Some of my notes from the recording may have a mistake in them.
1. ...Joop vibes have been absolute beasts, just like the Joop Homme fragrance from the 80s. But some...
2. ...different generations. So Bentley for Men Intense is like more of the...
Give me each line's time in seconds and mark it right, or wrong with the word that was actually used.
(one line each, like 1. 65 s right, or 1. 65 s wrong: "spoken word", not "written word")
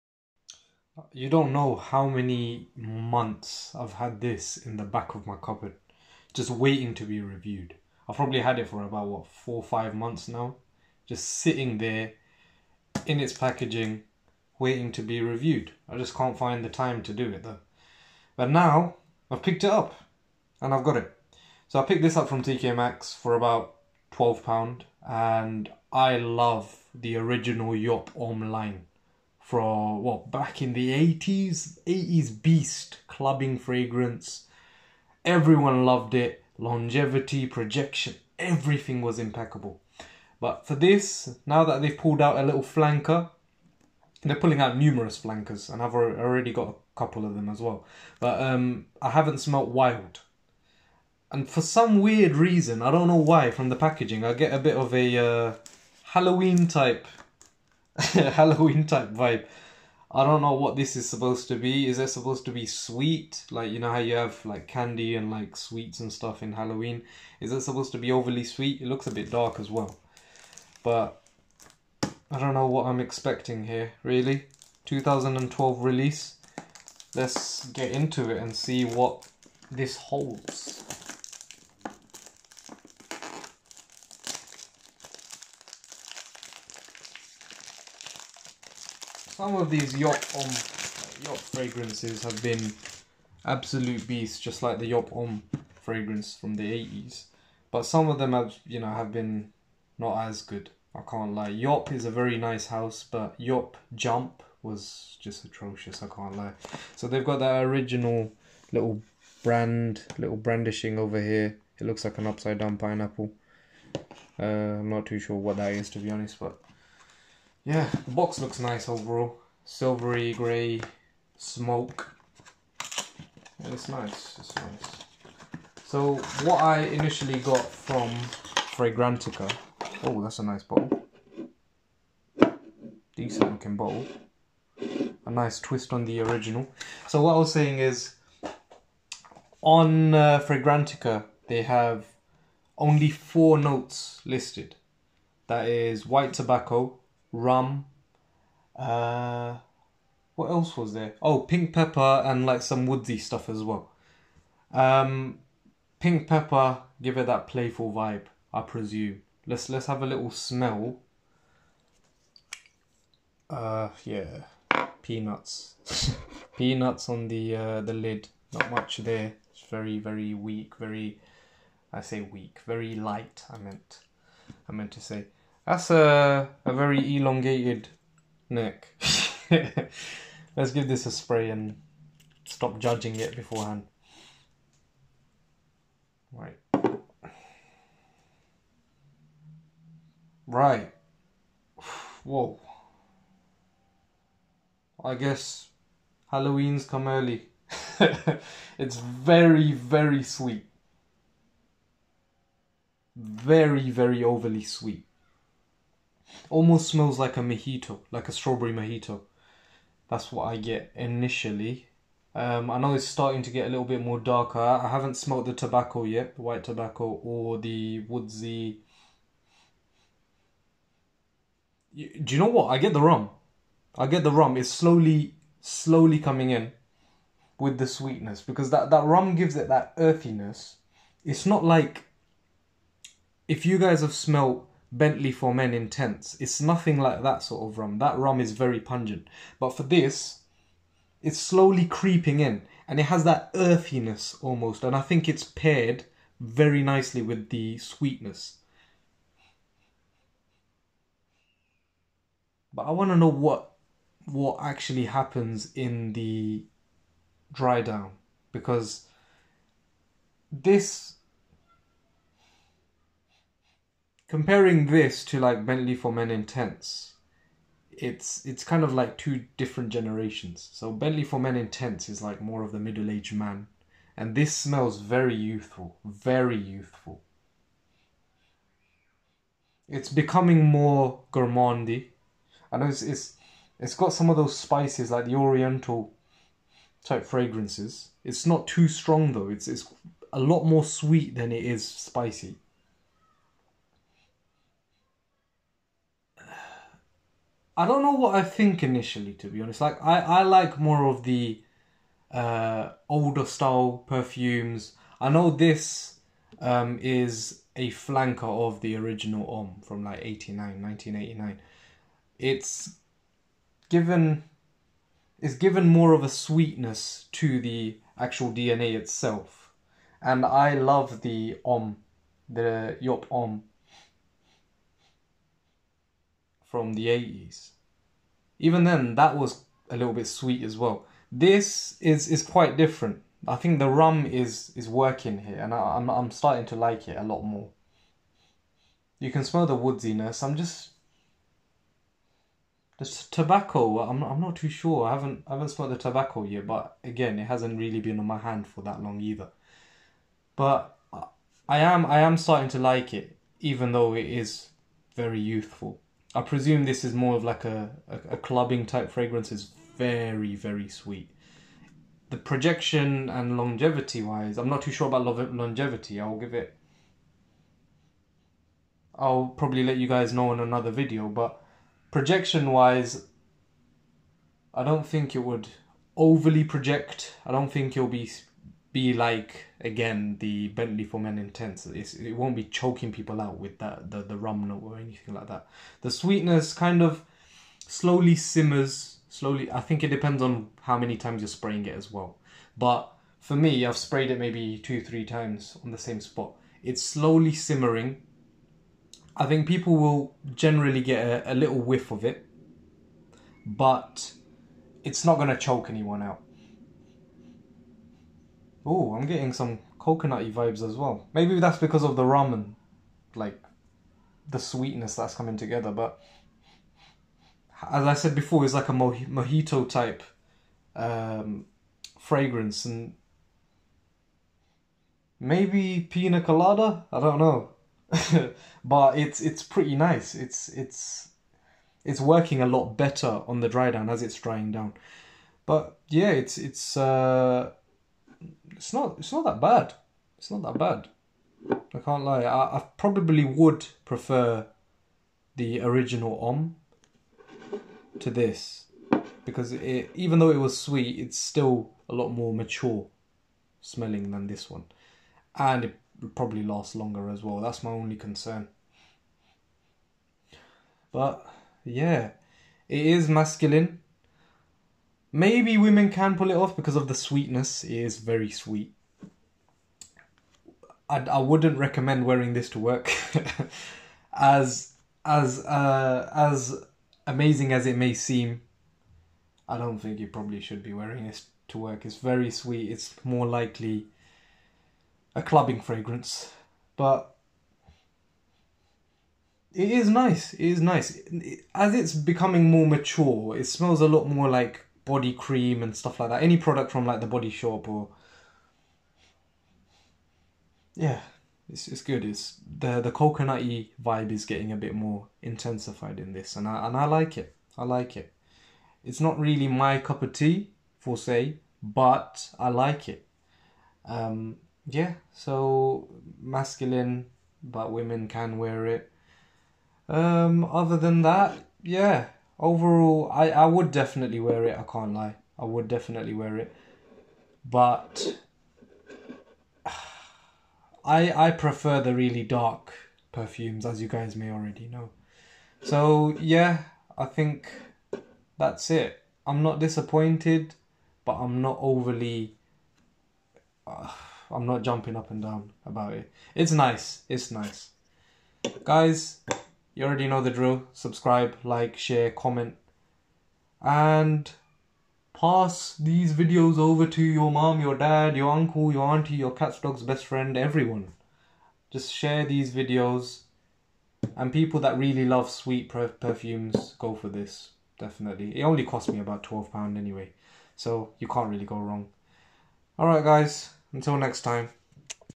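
1. 91 s wrong: "fragrances", not "vibes"
2. 269 s right.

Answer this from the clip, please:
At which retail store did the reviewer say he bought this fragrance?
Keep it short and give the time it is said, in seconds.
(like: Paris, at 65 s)
TK Maxx, at 22 s.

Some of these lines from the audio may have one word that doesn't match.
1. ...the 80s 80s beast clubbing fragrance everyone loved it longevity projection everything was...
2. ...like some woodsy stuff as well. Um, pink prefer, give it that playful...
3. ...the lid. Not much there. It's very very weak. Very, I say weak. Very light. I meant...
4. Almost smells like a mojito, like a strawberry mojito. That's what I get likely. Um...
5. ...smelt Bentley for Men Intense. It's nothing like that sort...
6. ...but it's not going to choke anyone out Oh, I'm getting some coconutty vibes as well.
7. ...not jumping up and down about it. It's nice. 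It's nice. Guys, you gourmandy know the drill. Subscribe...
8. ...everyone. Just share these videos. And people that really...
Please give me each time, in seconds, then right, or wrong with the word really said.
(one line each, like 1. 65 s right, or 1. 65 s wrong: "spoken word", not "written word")
1. 30 s right
2. 152 s wrong: "pepper", not "prefer"
3. 167 s right
4. 206 s wrong: "initially", not "likely"
5. 234 s right
6. 403 s right
7. 544 s wrong: "already", not "gourmandy"
8. 560 s right.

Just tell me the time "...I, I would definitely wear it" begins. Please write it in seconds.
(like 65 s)
523 s.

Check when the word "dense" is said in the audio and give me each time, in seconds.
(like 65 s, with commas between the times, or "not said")
not said.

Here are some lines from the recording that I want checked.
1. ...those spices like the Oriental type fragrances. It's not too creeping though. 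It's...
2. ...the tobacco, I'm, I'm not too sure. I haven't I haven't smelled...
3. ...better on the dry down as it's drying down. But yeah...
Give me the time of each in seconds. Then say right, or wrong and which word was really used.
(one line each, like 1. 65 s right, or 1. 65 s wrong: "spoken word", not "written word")
1. 284 s wrong: "strong", not "creeping"
2. 342 s right
3. 432 s right.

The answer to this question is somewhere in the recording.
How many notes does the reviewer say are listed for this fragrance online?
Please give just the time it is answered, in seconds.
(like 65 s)
143 s.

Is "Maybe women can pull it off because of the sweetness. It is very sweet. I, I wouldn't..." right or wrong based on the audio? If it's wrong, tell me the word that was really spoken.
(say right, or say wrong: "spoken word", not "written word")
right.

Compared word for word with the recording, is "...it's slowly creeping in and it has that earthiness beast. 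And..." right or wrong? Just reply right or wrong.
wrong.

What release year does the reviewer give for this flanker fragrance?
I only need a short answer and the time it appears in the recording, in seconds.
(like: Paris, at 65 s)
2012, at 74 s.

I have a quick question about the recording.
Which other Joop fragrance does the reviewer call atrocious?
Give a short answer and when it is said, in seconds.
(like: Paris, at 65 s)
Joop Jump, at 103 s.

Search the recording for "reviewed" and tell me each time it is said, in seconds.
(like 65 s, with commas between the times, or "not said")
7 s, 15 s.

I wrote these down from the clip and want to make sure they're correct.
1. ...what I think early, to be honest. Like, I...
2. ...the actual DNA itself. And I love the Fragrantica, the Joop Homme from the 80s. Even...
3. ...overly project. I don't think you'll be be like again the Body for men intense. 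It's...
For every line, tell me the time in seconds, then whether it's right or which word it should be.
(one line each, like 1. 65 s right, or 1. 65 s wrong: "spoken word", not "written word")
1. 298 s wrong: "initially", not "early"
2. 317 s wrong: "Homme", not "Fragrantica"
3. 376 s wrong: "Bentley", not "Body".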